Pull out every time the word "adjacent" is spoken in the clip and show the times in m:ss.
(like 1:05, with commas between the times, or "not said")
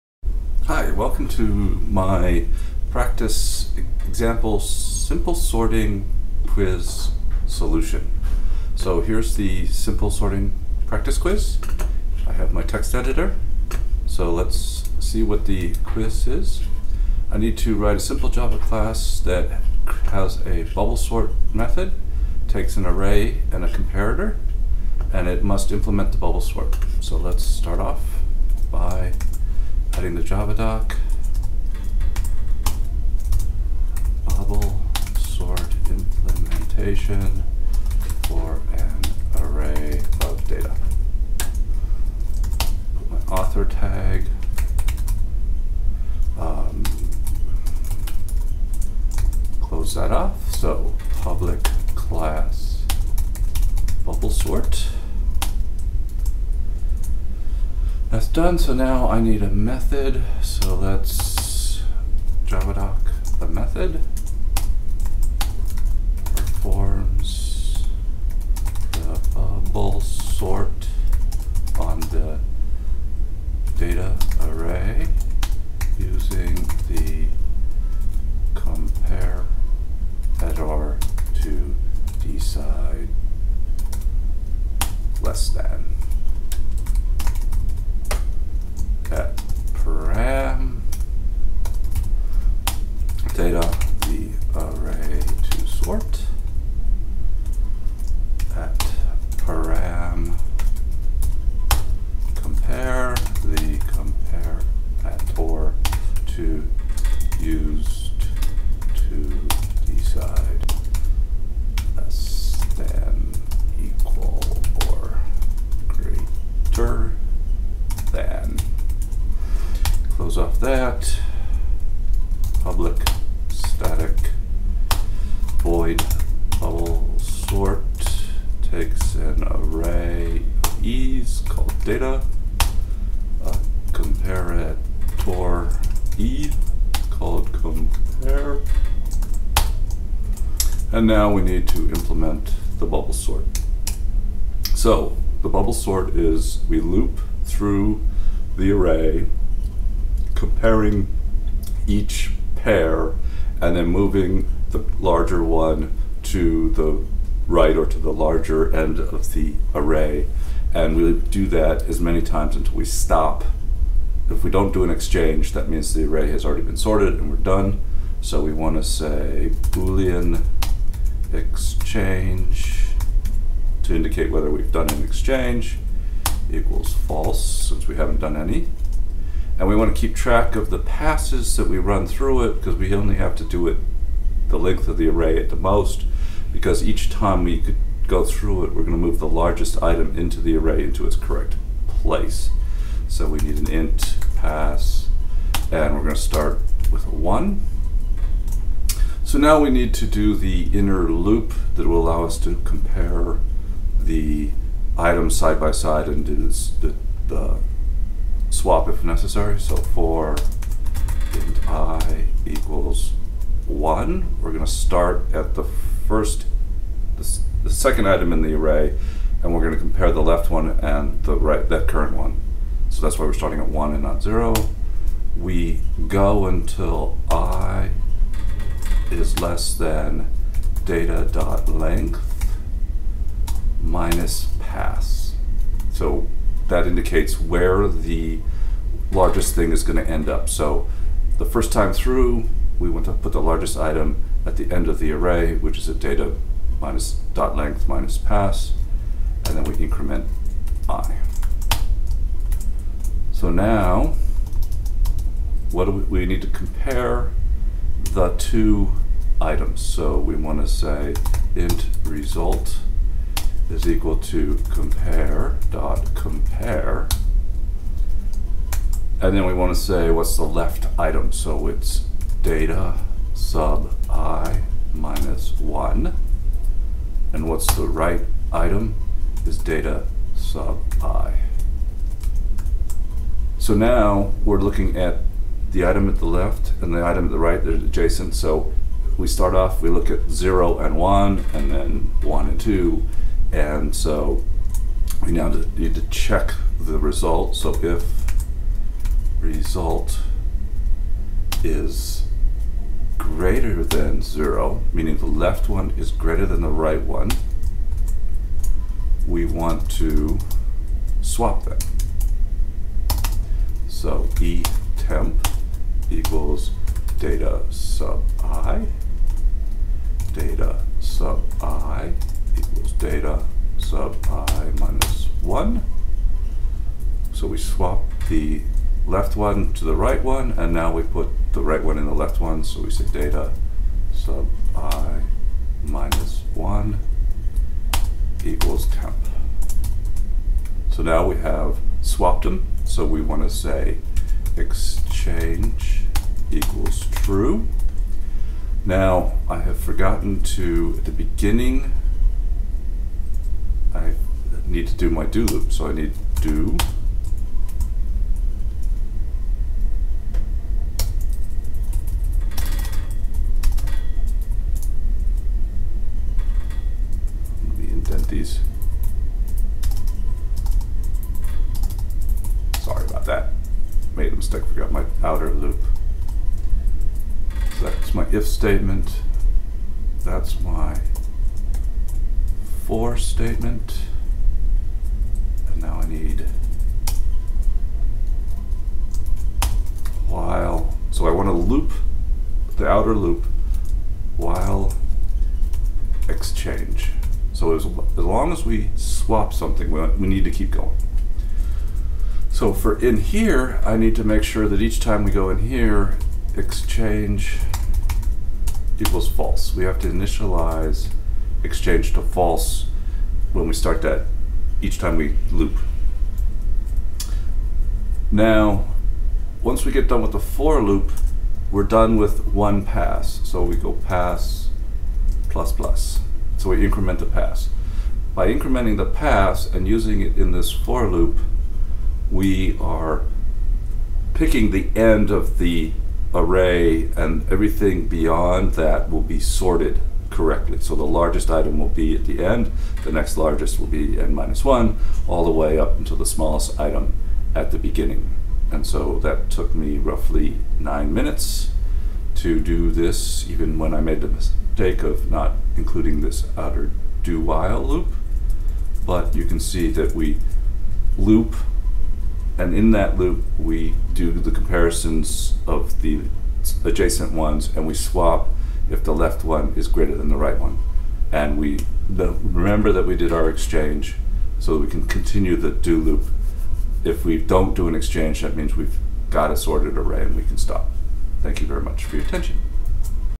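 4:47, 7:46.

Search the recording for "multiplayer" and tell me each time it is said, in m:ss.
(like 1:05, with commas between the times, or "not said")
not said.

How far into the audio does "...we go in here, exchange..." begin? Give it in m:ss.
6:45.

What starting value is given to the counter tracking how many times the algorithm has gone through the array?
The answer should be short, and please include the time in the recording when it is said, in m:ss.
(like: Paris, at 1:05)
1, at 3:16.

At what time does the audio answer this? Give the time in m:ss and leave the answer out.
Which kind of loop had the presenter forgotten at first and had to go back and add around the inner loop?
7:37.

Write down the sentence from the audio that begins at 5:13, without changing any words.
So E temp equals data sub i, data sub i equals data sub i minus 1.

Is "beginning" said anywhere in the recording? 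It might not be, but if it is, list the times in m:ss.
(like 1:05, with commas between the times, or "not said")
5:51, 7:27.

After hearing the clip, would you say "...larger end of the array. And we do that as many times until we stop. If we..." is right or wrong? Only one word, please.
right.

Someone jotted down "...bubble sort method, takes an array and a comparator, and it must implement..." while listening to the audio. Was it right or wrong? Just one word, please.
right.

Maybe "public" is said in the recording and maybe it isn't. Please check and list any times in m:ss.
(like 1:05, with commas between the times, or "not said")
0:51, 2:02.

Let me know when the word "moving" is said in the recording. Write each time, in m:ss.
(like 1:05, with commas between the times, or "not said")
2:33.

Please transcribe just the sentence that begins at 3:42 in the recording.
So that's why we're starting at 1 and not 0.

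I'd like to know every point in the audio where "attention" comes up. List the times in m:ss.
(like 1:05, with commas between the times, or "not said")
8:02.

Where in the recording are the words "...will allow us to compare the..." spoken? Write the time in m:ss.
3:21.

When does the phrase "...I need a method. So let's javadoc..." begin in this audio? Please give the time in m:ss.
0:59.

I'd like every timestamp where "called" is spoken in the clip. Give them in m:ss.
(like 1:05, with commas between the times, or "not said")
2:11, 2:17.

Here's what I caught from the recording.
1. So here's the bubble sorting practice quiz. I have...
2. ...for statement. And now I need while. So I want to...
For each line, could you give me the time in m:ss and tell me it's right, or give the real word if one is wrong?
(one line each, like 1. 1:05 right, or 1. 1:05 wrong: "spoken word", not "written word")
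1. 0:08 wrong: "simple", not "bubble"
2. 6:22 right.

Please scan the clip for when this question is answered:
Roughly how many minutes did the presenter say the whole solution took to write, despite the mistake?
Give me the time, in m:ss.
7:30.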